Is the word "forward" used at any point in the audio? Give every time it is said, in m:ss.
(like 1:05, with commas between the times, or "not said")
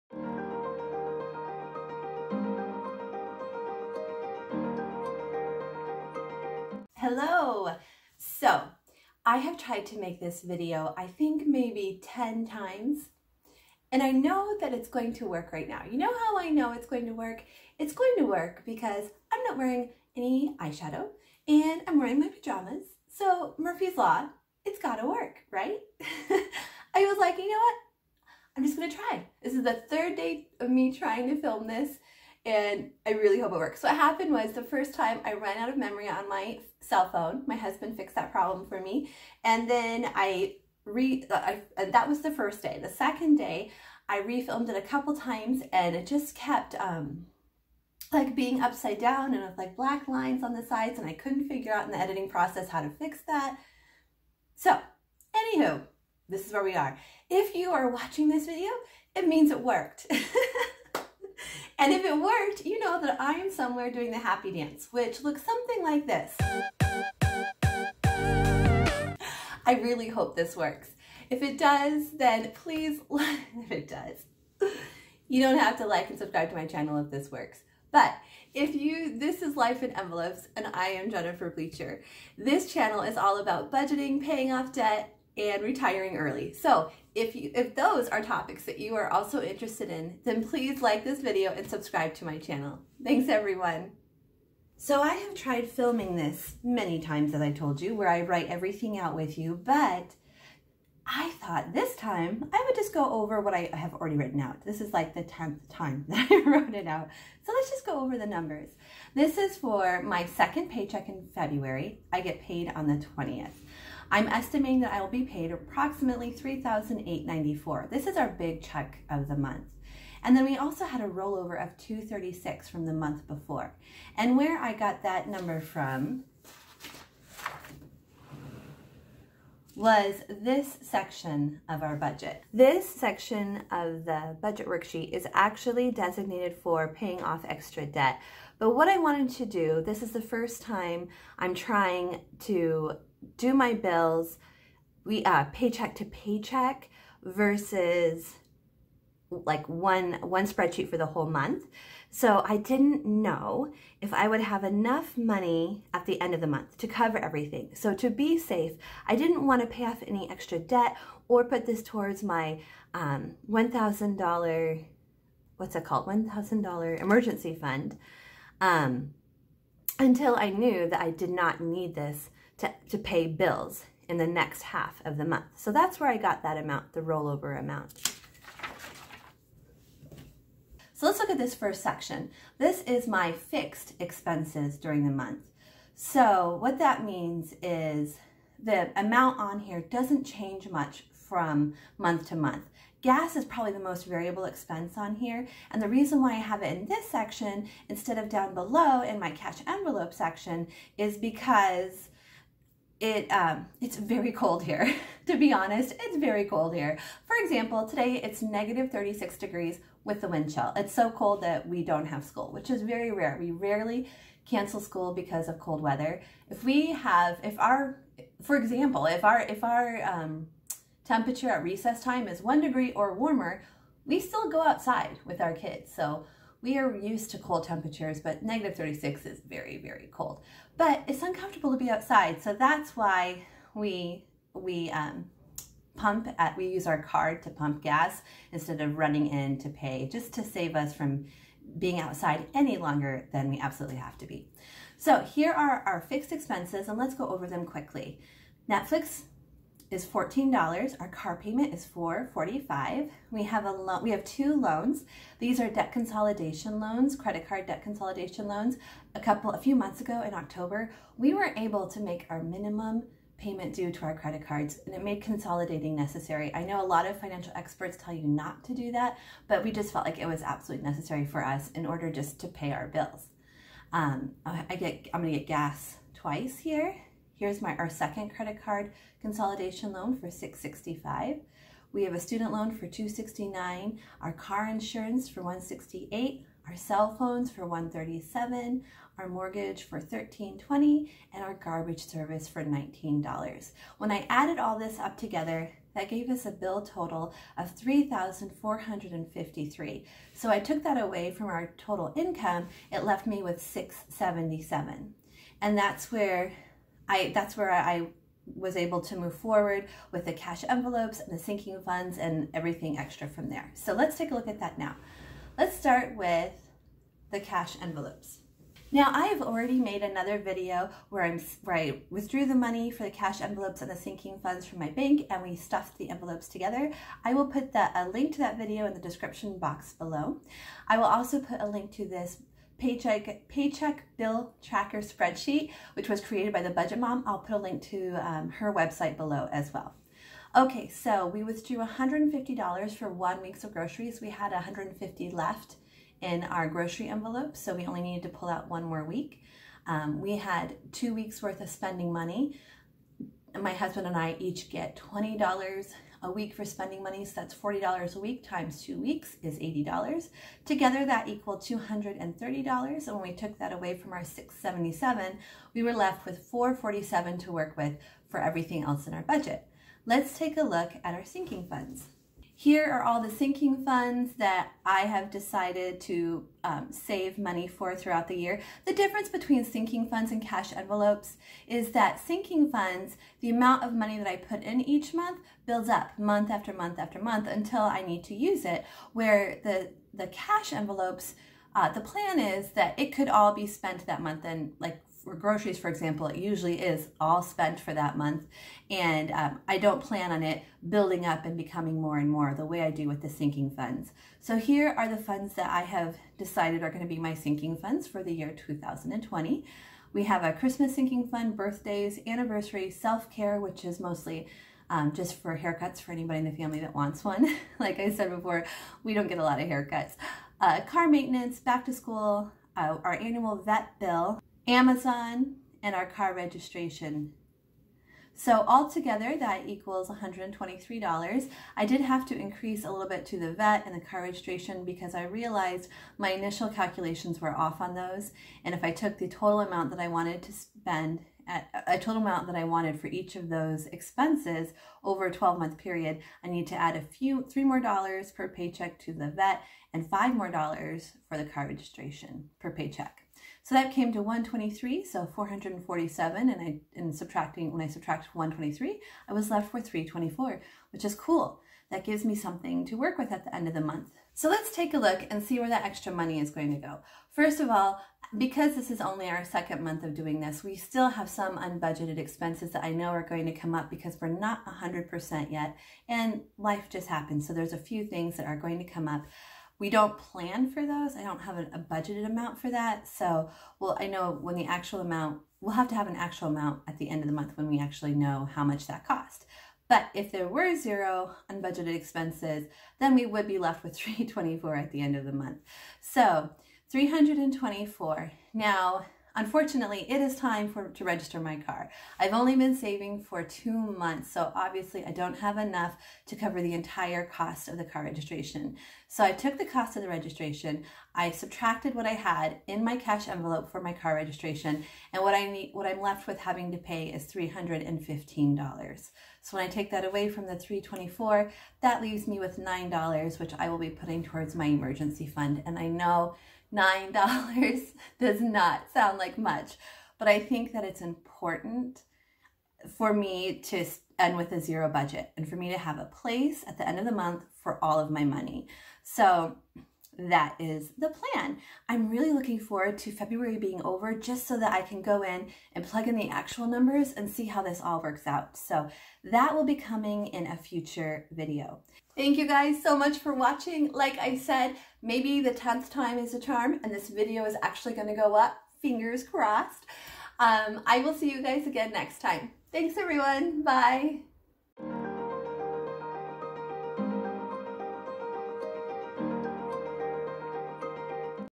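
5:09, 9:02.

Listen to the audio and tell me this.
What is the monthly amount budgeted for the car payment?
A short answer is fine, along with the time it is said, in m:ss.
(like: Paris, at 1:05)
$445, at 4:11.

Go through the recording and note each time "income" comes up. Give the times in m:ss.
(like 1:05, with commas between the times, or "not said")
5:02.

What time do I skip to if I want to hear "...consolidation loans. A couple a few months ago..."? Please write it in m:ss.
4:17.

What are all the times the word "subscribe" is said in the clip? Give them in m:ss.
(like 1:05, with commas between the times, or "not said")
1:16, 1:31.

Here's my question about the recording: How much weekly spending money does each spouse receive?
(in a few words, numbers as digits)
$20.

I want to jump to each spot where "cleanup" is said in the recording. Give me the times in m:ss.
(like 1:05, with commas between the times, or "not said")
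not said.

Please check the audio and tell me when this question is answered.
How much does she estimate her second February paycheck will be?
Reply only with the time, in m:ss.
1:56.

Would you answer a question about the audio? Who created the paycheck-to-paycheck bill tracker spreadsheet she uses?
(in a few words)
The Budget Mom.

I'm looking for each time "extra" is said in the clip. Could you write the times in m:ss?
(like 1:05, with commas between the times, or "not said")
2:17, 2:40, 5:12, 7:45.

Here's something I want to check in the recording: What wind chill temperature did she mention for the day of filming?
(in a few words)
-36 degrees.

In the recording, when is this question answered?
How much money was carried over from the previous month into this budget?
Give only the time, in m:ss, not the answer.
2:01.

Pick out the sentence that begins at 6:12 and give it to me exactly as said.
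Here are all the sinking funds that I have decided to um, save money for throughout the year.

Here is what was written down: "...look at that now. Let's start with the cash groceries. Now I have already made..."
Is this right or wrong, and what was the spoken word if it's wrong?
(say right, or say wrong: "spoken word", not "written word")
wrong: "envelopes", not "groceries".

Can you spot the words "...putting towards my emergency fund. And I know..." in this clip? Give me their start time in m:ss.
8:43.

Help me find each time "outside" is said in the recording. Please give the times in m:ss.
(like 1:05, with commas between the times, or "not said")
3:44, 3:51, 4:01.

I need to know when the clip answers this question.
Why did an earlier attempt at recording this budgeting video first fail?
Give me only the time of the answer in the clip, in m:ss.
0:35.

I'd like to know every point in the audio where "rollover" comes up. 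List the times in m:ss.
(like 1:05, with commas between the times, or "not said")
2:01, 2:57.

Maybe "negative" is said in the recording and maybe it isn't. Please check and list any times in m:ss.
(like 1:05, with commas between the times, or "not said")
3:28, 3:48.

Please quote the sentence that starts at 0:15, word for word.
You know how I know it's going to work?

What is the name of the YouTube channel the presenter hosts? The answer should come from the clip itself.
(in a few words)
Life in Envelopes.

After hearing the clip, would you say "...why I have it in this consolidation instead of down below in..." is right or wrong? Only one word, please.
wrong.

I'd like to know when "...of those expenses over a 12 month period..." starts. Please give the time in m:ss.
7:23.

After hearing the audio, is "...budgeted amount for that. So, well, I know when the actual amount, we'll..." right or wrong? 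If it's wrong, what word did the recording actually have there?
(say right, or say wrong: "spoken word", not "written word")
right.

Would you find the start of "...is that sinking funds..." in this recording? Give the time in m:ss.
6:21.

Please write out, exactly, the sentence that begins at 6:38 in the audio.
And um, I don't plan on it building up and becoming more and more the way I do with the sinking funds.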